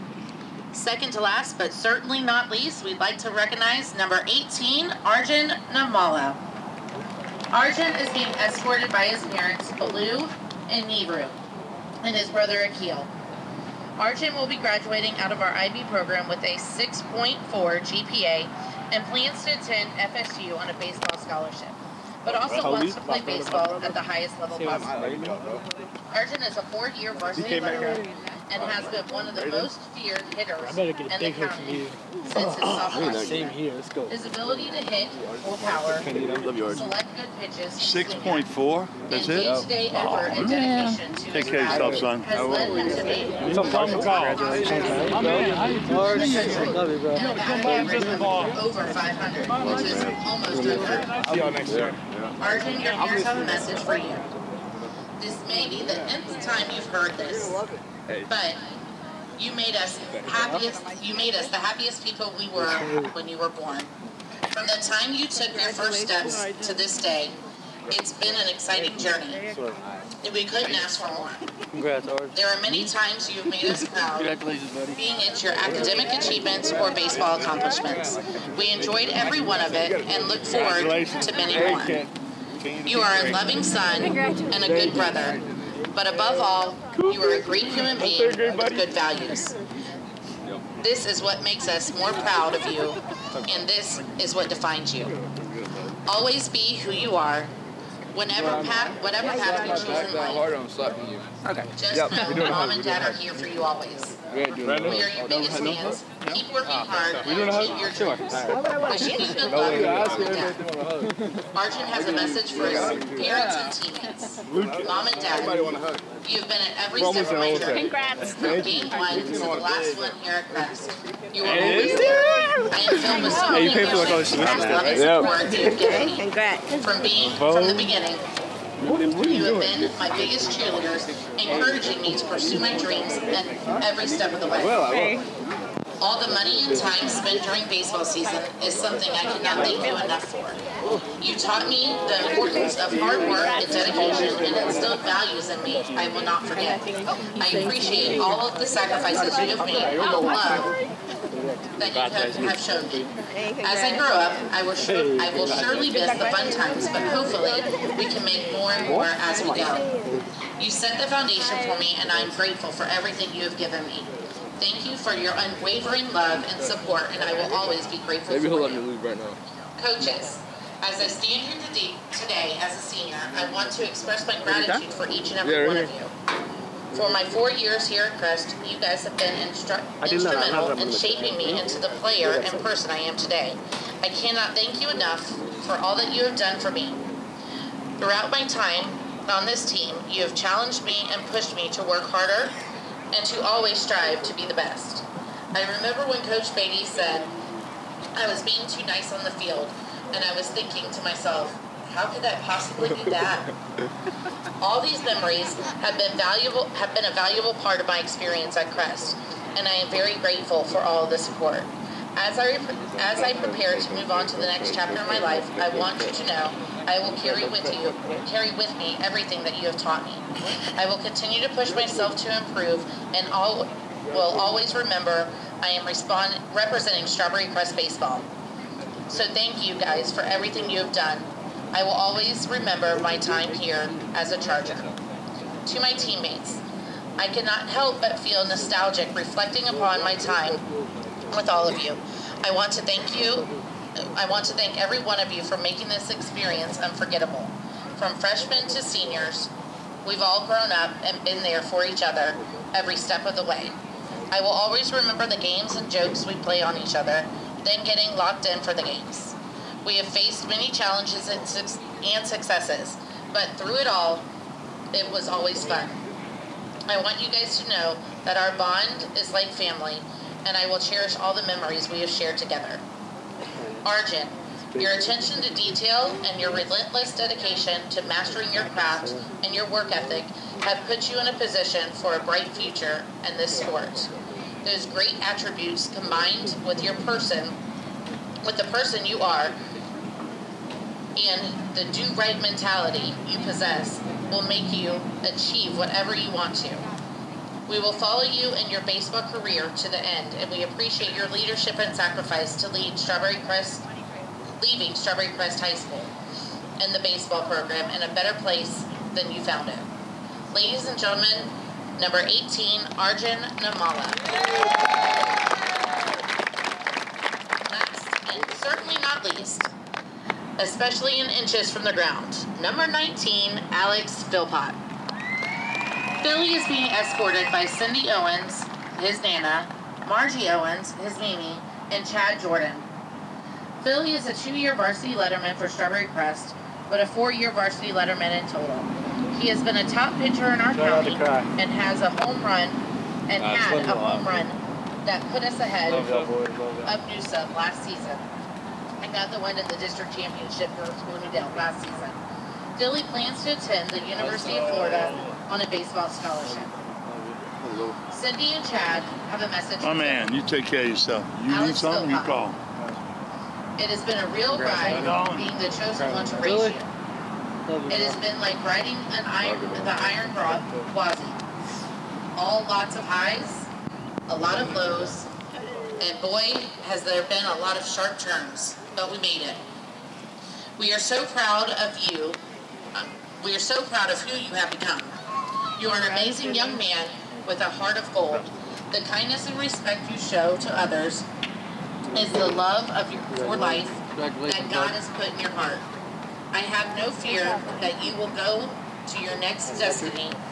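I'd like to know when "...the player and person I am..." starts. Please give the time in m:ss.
3:01.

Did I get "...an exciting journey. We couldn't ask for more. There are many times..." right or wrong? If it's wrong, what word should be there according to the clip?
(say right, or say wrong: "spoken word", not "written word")
right.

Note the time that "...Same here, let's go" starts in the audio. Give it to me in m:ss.
0:33.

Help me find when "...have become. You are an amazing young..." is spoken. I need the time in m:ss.
6:24.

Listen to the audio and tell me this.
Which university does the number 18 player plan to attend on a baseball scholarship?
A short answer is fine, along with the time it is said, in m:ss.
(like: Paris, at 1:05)
FSU, at 0:19.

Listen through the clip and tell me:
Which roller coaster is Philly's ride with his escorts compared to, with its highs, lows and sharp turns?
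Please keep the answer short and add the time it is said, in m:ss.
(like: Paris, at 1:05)
Gwazi, at 6:10.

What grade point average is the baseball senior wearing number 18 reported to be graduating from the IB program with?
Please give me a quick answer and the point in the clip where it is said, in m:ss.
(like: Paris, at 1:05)
6.4, at 0:16.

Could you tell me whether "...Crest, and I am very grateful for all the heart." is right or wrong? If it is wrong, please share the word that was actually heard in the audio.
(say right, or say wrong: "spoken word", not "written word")
wrong: "support", not "heart".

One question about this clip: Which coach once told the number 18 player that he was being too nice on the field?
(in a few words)
Coach Beatty.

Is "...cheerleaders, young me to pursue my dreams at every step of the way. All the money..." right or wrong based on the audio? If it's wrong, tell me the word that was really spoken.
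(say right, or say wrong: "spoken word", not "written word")
wrong: "encouraging", not "young".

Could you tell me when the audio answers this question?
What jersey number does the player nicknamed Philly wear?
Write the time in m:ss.
5:22.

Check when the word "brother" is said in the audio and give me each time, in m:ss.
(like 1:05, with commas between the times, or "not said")
0:12, 1:24.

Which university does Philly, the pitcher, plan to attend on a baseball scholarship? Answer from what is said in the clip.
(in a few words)
University of Florida.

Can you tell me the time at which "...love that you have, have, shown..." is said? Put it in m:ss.
2:30.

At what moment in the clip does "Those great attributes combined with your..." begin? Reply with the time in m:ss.
4:44.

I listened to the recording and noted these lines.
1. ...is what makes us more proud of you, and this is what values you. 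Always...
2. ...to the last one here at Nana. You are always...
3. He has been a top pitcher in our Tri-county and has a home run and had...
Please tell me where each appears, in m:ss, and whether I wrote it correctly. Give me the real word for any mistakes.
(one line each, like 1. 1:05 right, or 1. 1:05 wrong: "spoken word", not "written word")
1. 1:31 wrong: "defines", not "values"
2. 1:59 wrong: "Crest", not "Nana"
3. 5:39 right.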